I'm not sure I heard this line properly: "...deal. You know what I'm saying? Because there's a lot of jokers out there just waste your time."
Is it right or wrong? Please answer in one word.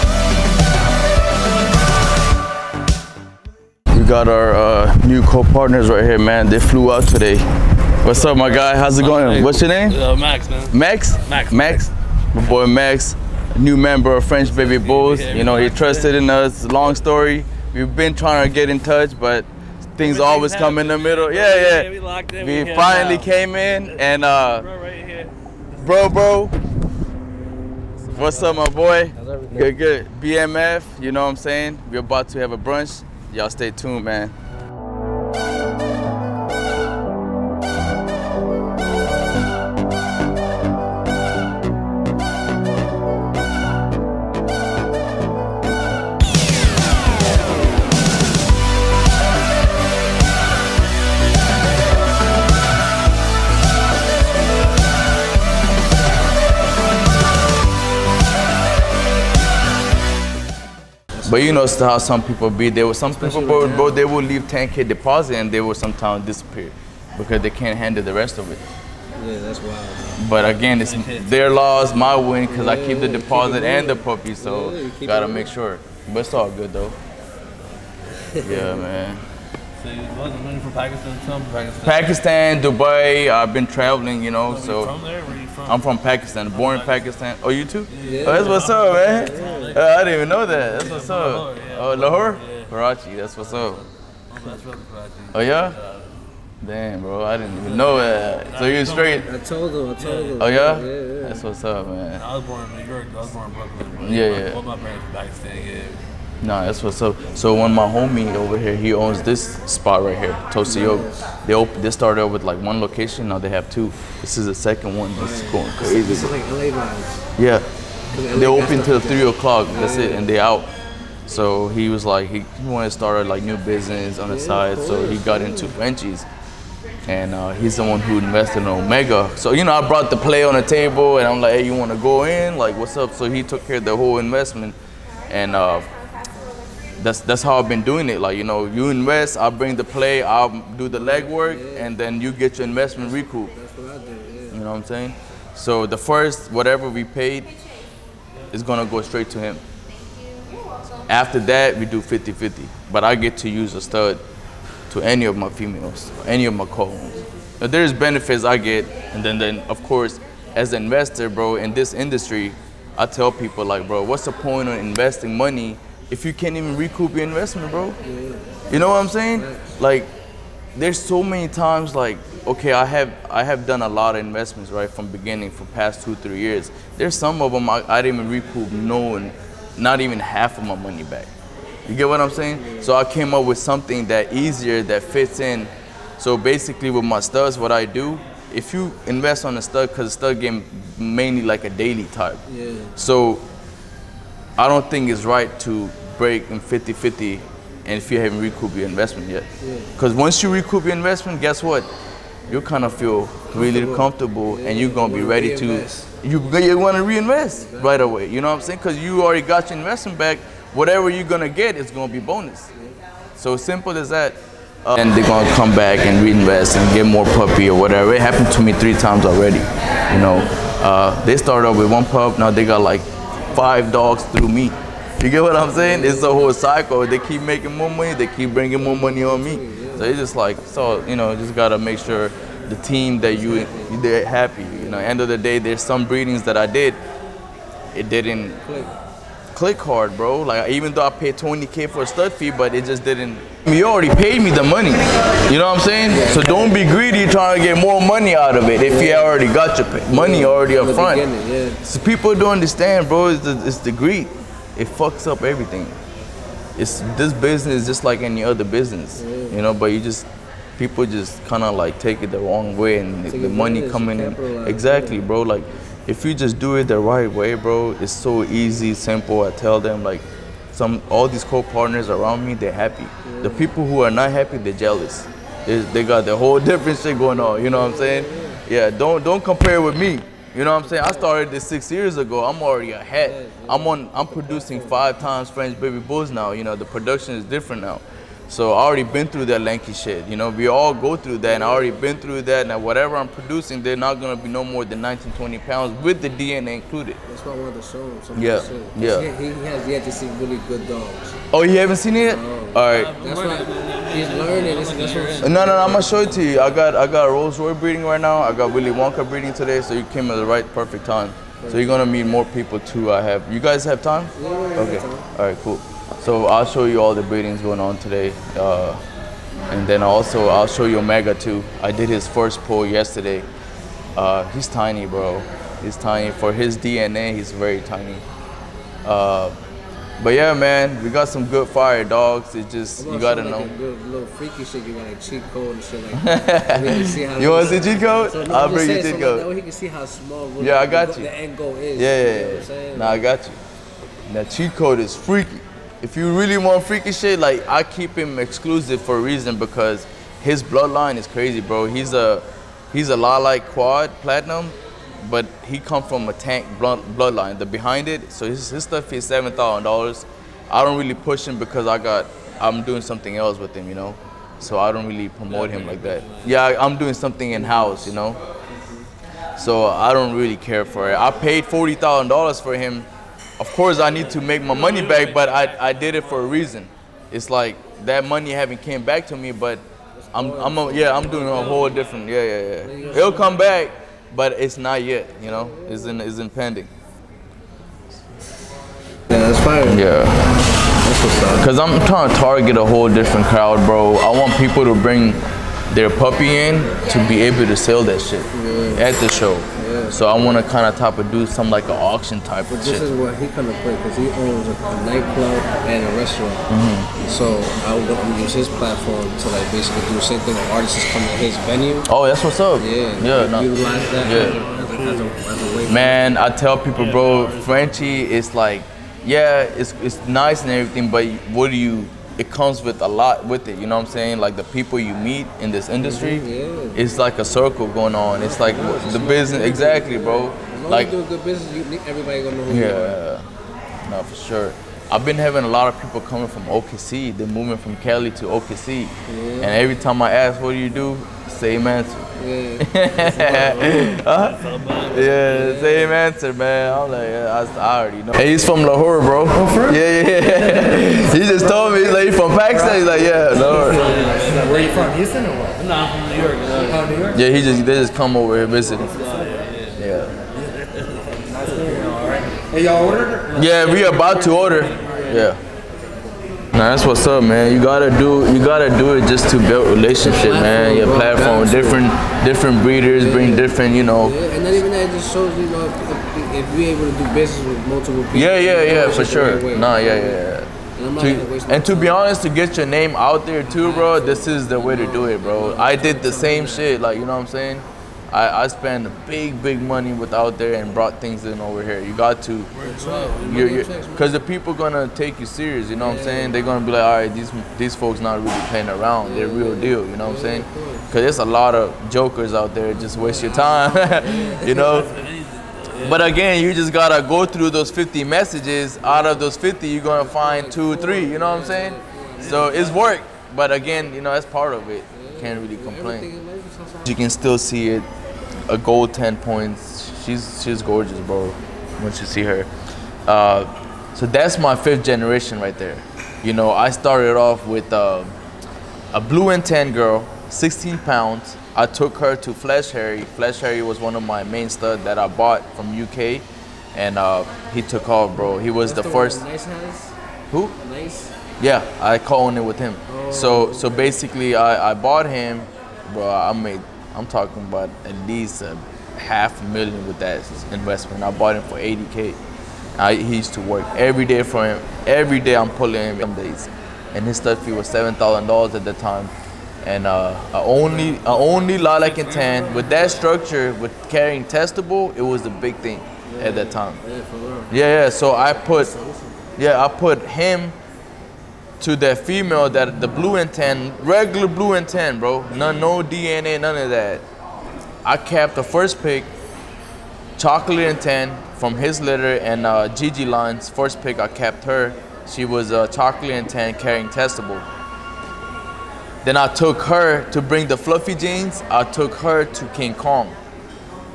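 right.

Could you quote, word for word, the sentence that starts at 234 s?
You know, end of the day, there's some breedings that I did.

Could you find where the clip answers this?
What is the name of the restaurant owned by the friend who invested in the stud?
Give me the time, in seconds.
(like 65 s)
110 s.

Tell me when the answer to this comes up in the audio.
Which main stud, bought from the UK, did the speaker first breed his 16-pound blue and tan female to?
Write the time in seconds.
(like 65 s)
531 s.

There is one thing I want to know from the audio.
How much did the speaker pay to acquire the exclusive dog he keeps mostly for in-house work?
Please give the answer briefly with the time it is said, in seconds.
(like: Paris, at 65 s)
$40,000, at 371 s.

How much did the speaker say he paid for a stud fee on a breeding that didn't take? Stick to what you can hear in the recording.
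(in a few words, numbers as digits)
20k.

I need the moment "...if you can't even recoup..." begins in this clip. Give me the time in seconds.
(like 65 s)
166 s.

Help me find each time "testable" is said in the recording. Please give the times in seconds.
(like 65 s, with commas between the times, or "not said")
564 s, 587 s.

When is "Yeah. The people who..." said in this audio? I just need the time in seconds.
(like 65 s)
273 s.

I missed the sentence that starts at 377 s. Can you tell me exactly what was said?
It's like that money haven't came back to me, but I'm I'm a, yeah I'm doing a whole different yeah yeah yeah.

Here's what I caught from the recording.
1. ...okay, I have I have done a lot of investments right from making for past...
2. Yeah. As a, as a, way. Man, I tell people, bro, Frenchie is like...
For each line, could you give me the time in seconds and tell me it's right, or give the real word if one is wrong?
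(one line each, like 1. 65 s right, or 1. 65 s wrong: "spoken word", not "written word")
1. 172 s wrong: "beginning", not "making"
2. 414 s right.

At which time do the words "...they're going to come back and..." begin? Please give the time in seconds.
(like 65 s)
215 s.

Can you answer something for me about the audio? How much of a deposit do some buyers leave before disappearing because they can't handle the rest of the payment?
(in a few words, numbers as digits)
10k.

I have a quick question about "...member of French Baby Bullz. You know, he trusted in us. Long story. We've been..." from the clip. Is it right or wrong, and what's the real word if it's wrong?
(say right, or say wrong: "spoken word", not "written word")
right.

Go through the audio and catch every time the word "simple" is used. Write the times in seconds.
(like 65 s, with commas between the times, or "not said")
213 s, 268 s.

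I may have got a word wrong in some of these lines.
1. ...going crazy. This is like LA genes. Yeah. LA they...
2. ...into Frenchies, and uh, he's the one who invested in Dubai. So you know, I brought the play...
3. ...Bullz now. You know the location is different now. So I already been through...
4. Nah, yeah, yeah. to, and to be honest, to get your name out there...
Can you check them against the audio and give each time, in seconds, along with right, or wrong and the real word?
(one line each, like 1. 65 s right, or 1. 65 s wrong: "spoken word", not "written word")
1. 115 s wrong: "vibes", not "genes"
2. 125 s wrong: "Omega", not "Dubai"
3. 285 s wrong: "production", not "location"
4. 479 s right.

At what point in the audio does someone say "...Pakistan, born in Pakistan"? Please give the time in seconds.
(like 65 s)
85 s.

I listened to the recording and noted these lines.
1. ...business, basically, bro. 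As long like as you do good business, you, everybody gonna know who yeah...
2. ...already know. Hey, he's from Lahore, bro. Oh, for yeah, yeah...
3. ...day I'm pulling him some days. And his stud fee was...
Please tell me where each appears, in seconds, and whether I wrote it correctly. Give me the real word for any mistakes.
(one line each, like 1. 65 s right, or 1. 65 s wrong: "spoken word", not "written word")
1. 429 s wrong: "exactly", not "basically"
2. 447 s right
3. 555 s right.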